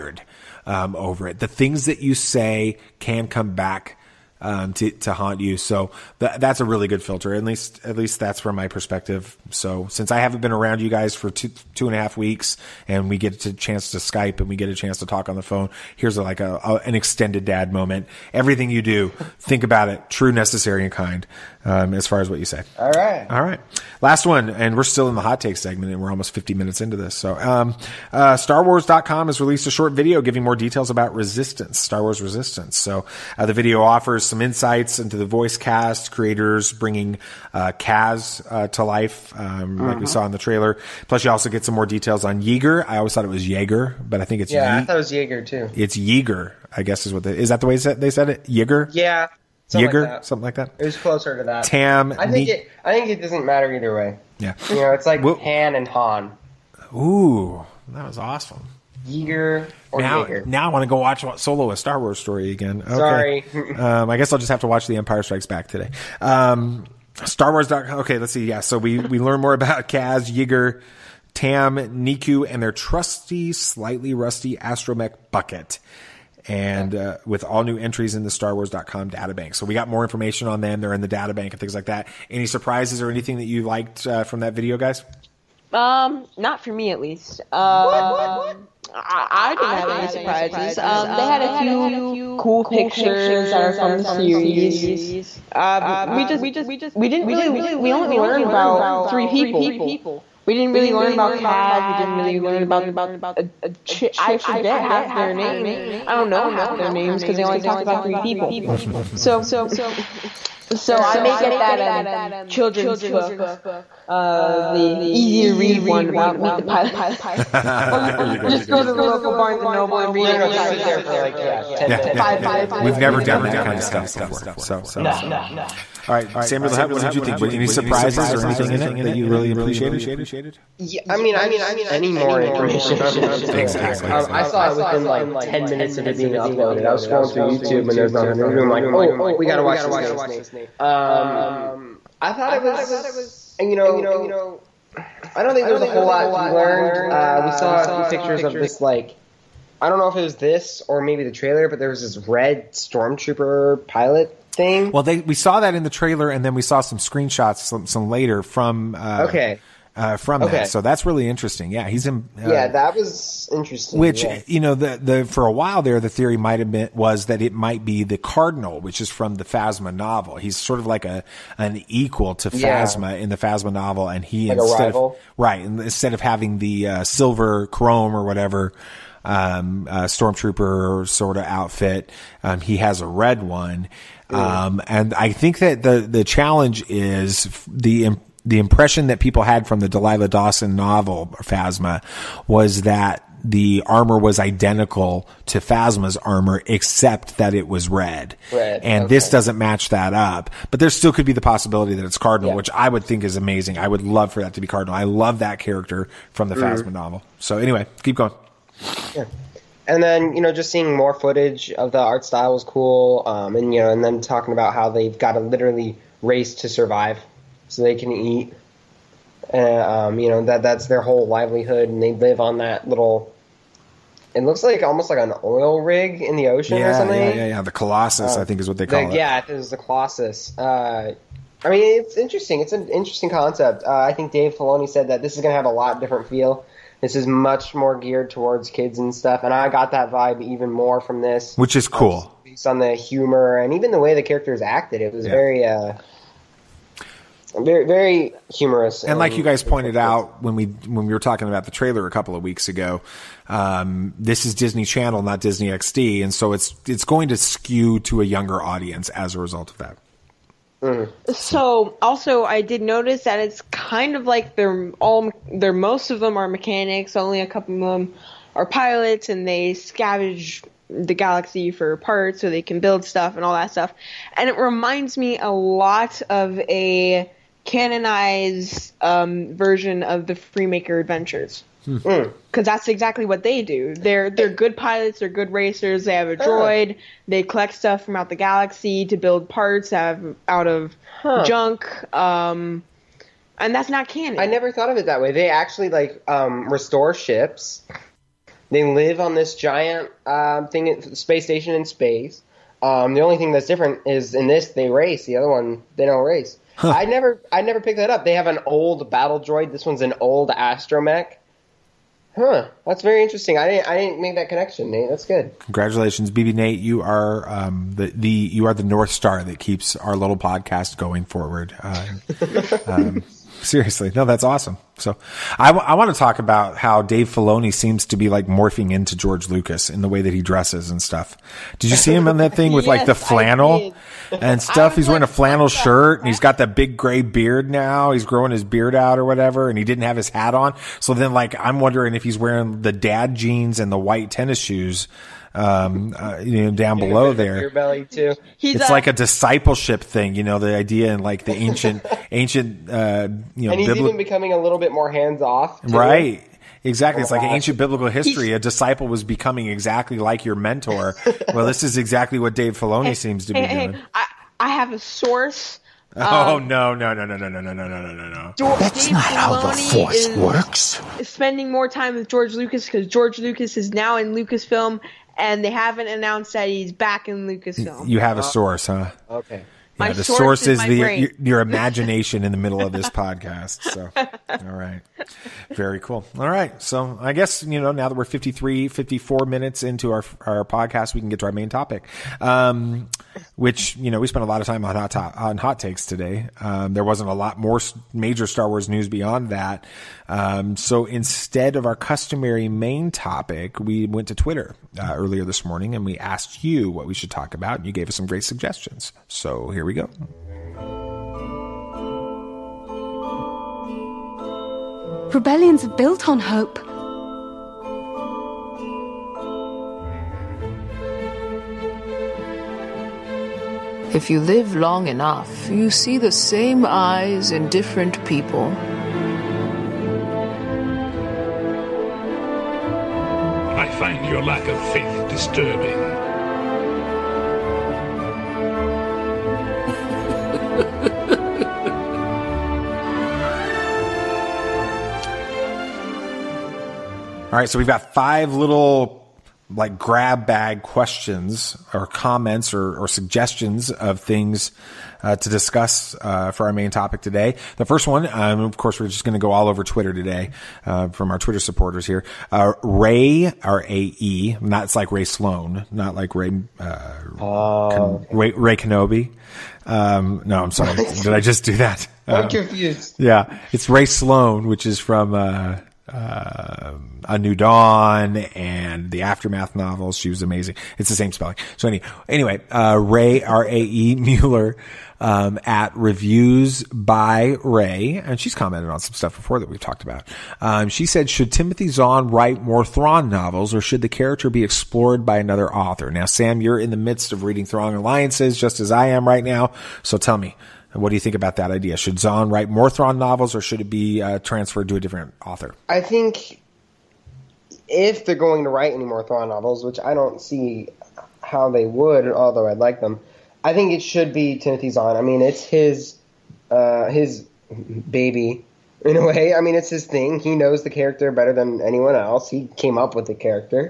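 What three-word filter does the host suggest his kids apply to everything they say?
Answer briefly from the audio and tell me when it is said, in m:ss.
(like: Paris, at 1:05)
True, necessary, and kind, at 0:20.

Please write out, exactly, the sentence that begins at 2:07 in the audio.
Were any surprises or anything in it that you really appreciated?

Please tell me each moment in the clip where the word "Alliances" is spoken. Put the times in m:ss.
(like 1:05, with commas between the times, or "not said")
8:17.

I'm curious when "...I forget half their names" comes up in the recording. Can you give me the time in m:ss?
1:44.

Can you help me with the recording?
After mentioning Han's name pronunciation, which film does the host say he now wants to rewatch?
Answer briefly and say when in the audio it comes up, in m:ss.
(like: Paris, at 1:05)
Solo: A Star Wars Story, at 1:01.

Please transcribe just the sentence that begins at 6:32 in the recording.
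Um, which, you know, we spent a lot of time on hot to- on hot takes today.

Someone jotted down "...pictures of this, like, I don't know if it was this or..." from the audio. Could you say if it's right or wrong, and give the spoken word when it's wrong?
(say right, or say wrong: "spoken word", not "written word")
right.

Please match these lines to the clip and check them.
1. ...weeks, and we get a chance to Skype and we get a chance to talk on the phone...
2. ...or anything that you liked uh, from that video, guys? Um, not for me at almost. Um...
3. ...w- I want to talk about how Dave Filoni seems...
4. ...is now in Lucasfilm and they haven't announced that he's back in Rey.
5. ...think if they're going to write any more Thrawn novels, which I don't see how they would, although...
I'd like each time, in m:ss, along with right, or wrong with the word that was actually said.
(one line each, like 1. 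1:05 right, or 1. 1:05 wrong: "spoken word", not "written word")
1. 0:12 right
2. 1:23 wrong: "least", not "almost"
3. 5:25 right
4. 6:13 wrong: "Lucasfilm", not "Rey"
5. 8:26 right.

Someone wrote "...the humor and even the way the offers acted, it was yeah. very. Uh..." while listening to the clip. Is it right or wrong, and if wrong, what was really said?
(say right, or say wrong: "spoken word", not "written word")
wrong: "characters", not "offers".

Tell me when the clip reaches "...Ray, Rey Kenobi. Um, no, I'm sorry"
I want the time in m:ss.
7:48.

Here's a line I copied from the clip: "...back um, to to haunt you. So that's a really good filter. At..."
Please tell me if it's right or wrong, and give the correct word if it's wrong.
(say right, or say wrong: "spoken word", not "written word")
right.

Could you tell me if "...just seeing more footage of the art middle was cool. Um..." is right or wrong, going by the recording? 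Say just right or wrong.
wrong.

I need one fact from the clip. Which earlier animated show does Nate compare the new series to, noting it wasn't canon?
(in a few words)
Freemaker Adventures.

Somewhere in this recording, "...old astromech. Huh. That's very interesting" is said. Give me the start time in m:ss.
5:10.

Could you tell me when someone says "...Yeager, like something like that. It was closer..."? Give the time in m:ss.
0:49.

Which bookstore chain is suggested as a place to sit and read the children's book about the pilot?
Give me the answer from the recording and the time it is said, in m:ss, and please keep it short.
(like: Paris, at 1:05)
Barnes and Noble, at 1:59.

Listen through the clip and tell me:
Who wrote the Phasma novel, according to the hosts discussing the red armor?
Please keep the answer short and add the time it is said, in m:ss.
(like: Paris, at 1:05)
Delilah Dawson, at 3:09.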